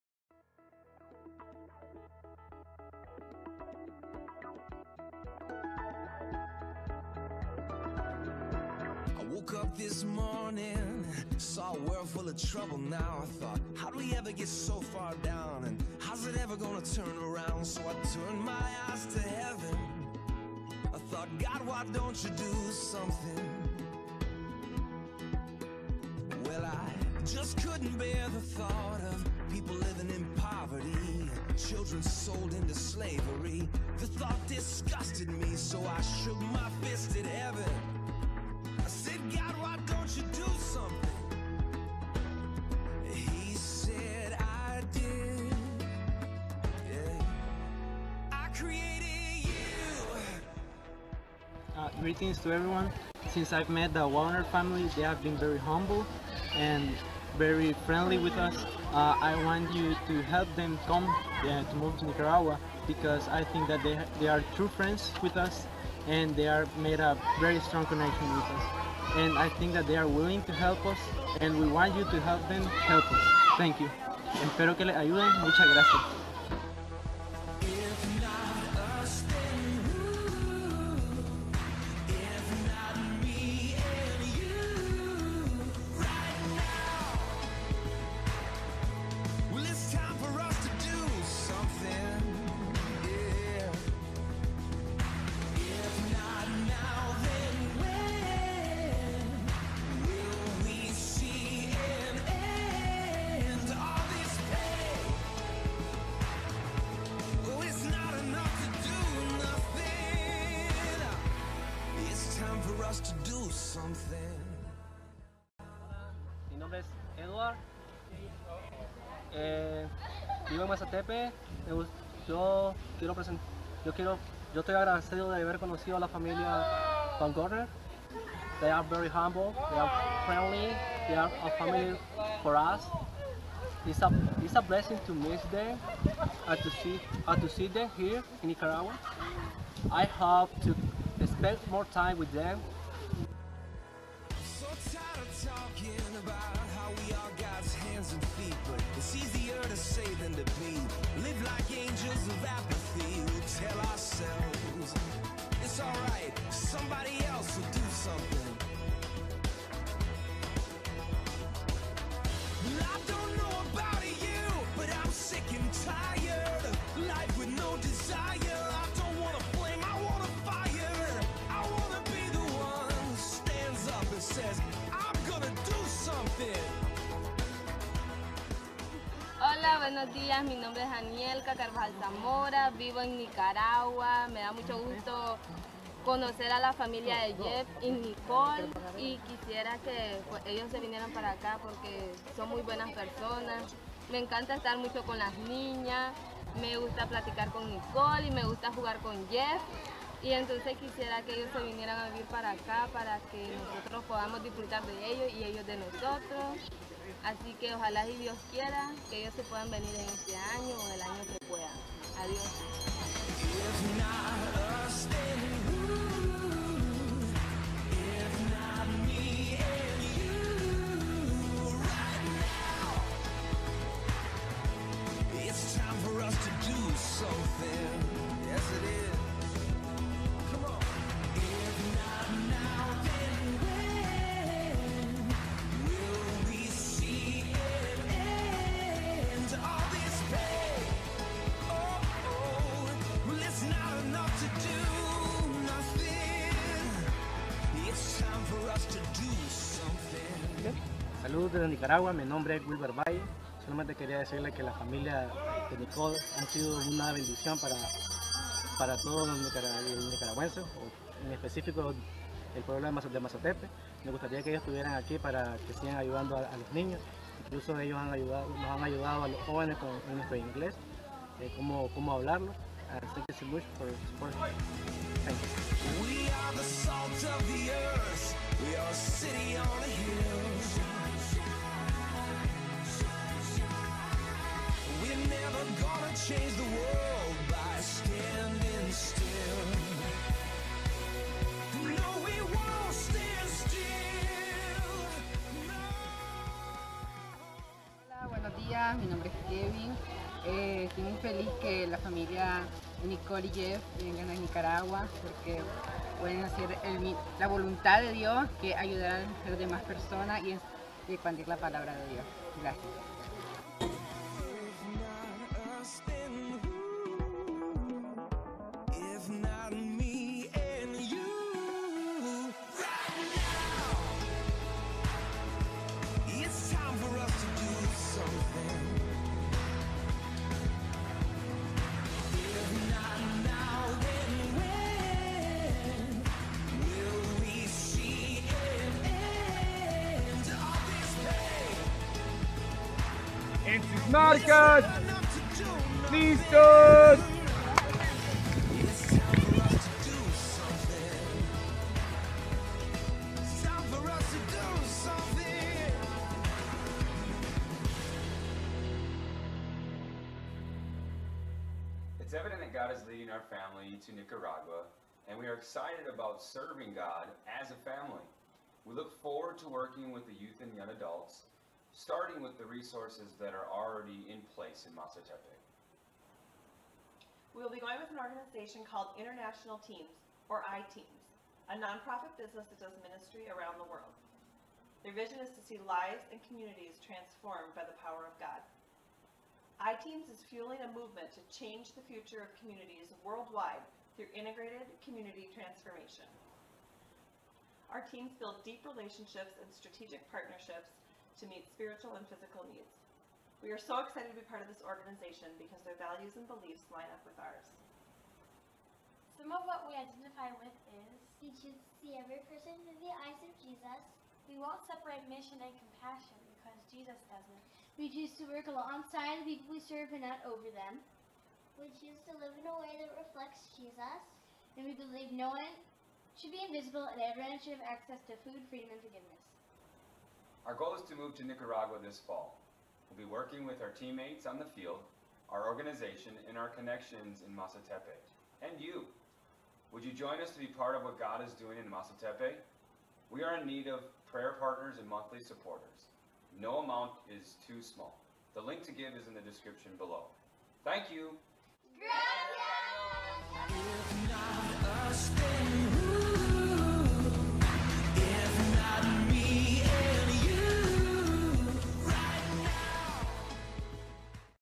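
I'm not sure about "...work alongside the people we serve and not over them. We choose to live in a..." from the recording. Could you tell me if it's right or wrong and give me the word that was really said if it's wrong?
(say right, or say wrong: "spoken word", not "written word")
right.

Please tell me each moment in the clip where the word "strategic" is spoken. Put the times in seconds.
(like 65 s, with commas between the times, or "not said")
399 s.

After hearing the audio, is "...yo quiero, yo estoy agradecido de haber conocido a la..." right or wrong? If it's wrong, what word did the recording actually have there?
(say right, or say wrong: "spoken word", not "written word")
right.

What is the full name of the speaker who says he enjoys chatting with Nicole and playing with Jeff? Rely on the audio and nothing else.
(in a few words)
Daniel Carvajal Zamora.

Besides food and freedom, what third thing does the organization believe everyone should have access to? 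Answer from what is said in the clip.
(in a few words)
Forgiveness.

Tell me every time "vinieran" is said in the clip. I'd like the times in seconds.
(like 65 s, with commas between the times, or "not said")
190 s, 201 s.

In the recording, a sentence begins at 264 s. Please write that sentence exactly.
Me gustaría que ellos estuvieran aquí para que sigan ayudando a, los niños.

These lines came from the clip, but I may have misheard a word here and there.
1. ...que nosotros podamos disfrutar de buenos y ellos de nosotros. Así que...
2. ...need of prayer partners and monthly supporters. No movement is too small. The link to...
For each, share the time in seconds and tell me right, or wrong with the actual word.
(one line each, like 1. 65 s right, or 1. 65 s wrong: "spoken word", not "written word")
1. 203 s wrong: "ellos", not "buenos"
2. 443 s wrong: "amount", not "movement".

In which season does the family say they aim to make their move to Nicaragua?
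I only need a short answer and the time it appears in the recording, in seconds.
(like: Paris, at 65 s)
Fall, at 432 s.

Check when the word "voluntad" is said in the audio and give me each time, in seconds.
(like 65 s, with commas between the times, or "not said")
307 s.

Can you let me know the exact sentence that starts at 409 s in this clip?
Some of what we identify with is We choose to see every person through the eyes of Jesus.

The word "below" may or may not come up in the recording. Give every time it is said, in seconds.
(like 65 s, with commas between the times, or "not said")
449 s.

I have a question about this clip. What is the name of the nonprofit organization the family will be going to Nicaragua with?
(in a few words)
International Teams.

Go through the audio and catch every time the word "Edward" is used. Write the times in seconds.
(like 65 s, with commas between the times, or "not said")
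117 s.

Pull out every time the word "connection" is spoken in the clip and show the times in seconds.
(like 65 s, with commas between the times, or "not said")
67 s, 436 s.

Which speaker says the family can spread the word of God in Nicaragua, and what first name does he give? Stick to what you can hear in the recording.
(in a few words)
Kevin.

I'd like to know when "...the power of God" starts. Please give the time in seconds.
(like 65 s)
387 s.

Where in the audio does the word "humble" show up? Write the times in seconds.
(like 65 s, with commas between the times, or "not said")
55 s, 129 s.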